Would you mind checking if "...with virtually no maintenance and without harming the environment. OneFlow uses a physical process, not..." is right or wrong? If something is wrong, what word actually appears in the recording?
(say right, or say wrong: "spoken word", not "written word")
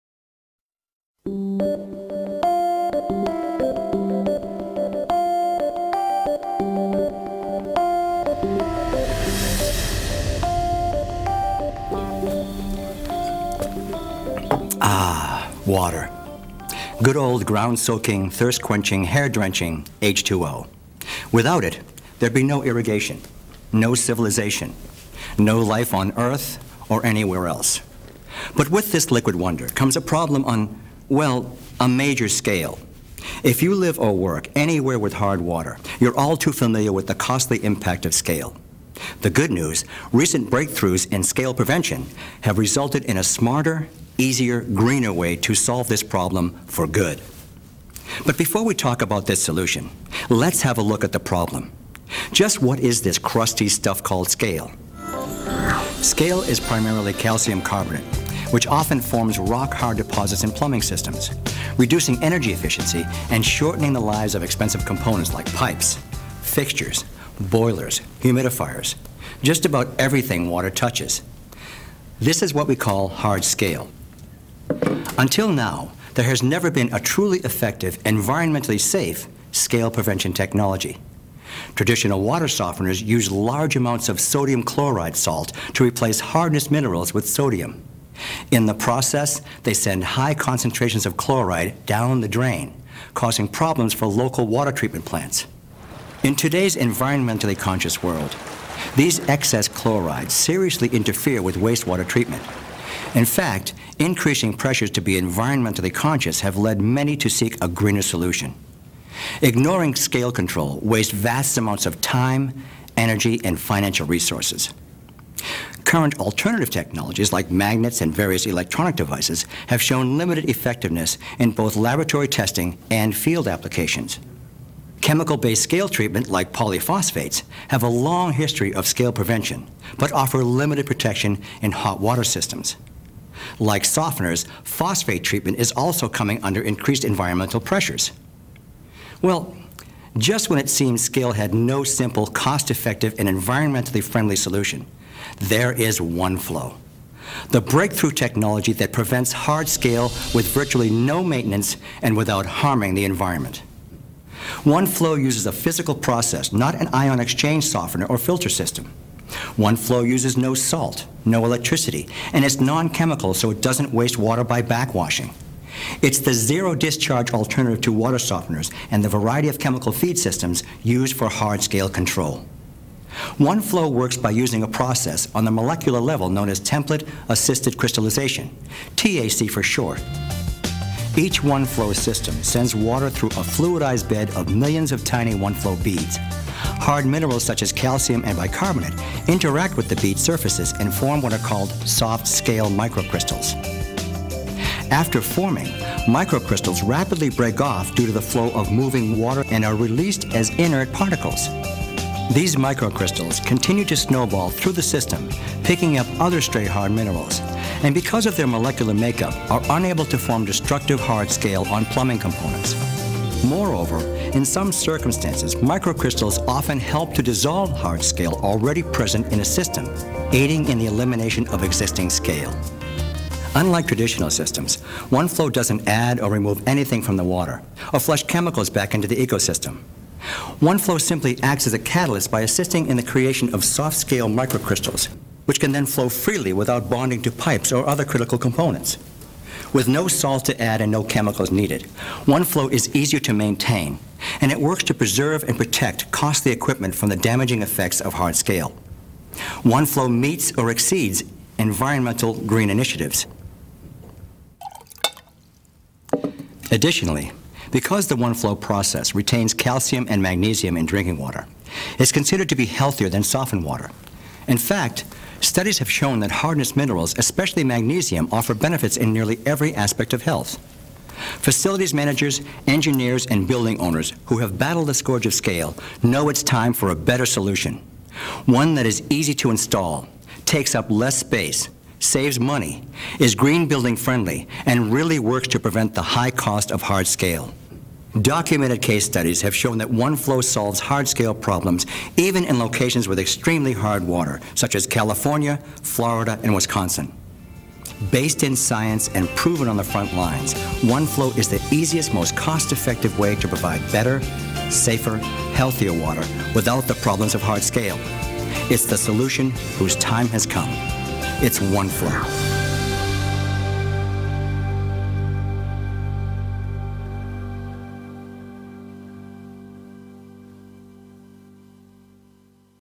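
right.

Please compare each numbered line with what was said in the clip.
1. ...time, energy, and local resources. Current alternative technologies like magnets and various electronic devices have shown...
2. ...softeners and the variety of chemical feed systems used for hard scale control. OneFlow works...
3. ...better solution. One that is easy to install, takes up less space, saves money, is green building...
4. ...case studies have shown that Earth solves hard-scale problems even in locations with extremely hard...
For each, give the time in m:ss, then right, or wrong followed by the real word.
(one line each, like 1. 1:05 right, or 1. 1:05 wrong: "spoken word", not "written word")
1. 1:52 wrong: "financial", not "local"
2. 2:48 right
3. 4:36 right
4. 4:48 wrong: "OneFlow", not "Earth".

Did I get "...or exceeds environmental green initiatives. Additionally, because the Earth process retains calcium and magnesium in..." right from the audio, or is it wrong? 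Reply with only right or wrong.
wrong.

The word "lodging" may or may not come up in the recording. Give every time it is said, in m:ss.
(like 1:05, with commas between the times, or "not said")
not said.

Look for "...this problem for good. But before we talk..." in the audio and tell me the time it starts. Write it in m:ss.
0:45.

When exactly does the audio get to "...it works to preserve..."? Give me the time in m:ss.
4:04.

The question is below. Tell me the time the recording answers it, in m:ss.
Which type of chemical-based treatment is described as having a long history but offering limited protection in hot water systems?
2:06.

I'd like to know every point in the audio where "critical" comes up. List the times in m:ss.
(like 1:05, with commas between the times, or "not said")
3:58.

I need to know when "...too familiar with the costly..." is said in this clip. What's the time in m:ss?
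0:36.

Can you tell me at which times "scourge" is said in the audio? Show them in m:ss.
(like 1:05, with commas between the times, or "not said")
4:34.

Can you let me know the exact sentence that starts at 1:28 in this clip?
In the process, they send high concentrations of chloride down the drain, causing problems for local water treatment plants.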